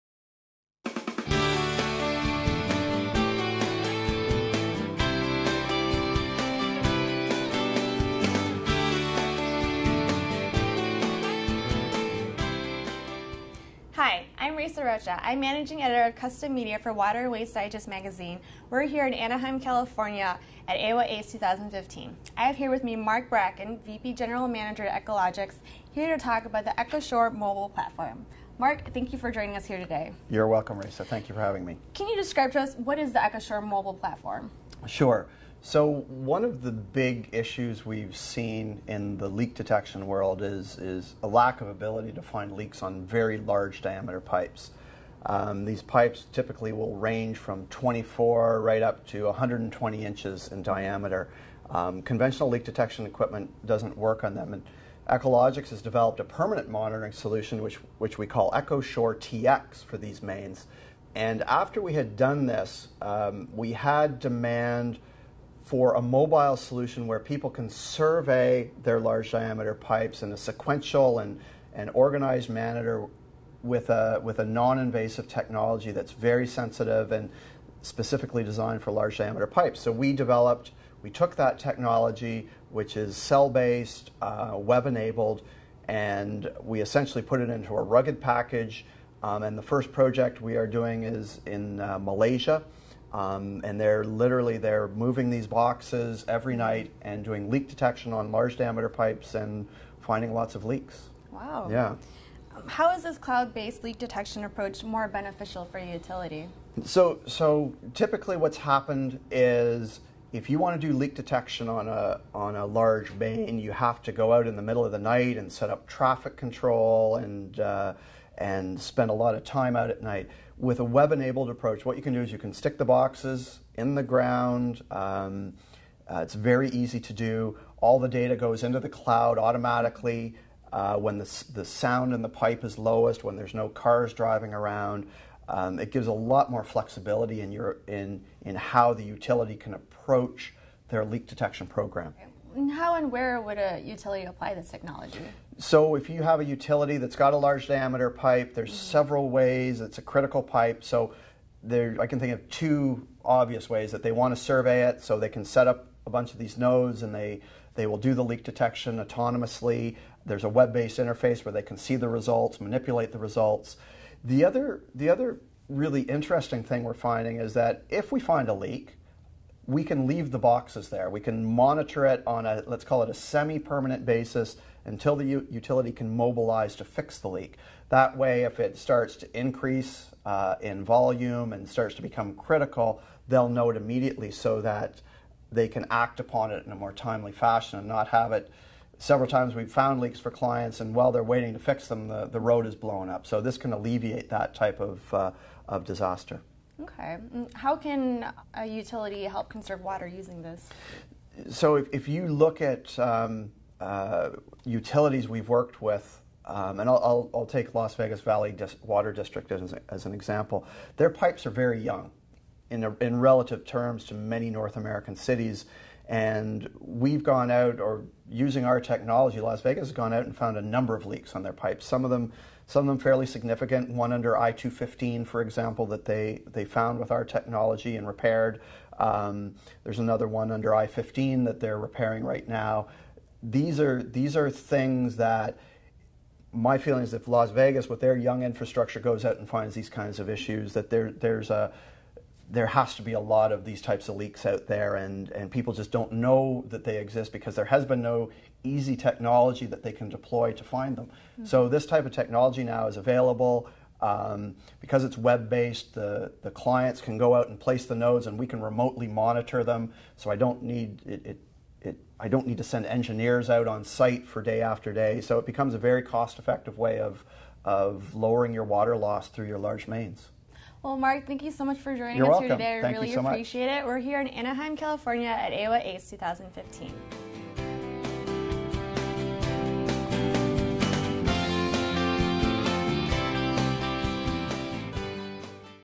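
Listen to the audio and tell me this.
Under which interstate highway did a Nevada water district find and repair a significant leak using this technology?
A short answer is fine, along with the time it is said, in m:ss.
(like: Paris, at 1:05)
I-215, at 3:44.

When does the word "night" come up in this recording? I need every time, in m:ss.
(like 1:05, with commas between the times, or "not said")
1:36, 1:54, 2:00.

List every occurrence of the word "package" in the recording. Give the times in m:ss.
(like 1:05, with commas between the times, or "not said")
1:28.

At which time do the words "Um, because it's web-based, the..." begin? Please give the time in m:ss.
4:14.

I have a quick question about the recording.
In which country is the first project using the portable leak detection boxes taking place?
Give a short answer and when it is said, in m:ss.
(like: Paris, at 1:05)
Malaysia, at 1:31.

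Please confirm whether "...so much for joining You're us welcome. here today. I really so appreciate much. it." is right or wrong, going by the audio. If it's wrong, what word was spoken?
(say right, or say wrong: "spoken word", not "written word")
right.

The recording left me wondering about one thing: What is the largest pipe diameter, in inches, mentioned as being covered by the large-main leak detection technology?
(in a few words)
120 inches.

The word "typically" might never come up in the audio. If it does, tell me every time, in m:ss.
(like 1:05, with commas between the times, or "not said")
0:46, 1:47.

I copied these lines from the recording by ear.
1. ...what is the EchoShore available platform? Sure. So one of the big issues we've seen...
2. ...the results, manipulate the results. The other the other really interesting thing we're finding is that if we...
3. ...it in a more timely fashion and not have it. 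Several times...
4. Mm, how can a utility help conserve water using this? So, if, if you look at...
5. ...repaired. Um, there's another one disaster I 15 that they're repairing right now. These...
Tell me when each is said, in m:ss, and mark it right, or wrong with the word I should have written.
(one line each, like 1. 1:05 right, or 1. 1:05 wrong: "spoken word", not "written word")
1. 0:32 wrong: "mobile", not "available"
2. 2:41 right
3. 3:06 right
4. 3:17 right
5. 3:48 wrong: "under", not "disaster".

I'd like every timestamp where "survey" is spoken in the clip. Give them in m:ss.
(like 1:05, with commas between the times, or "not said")
1:07, 2:34.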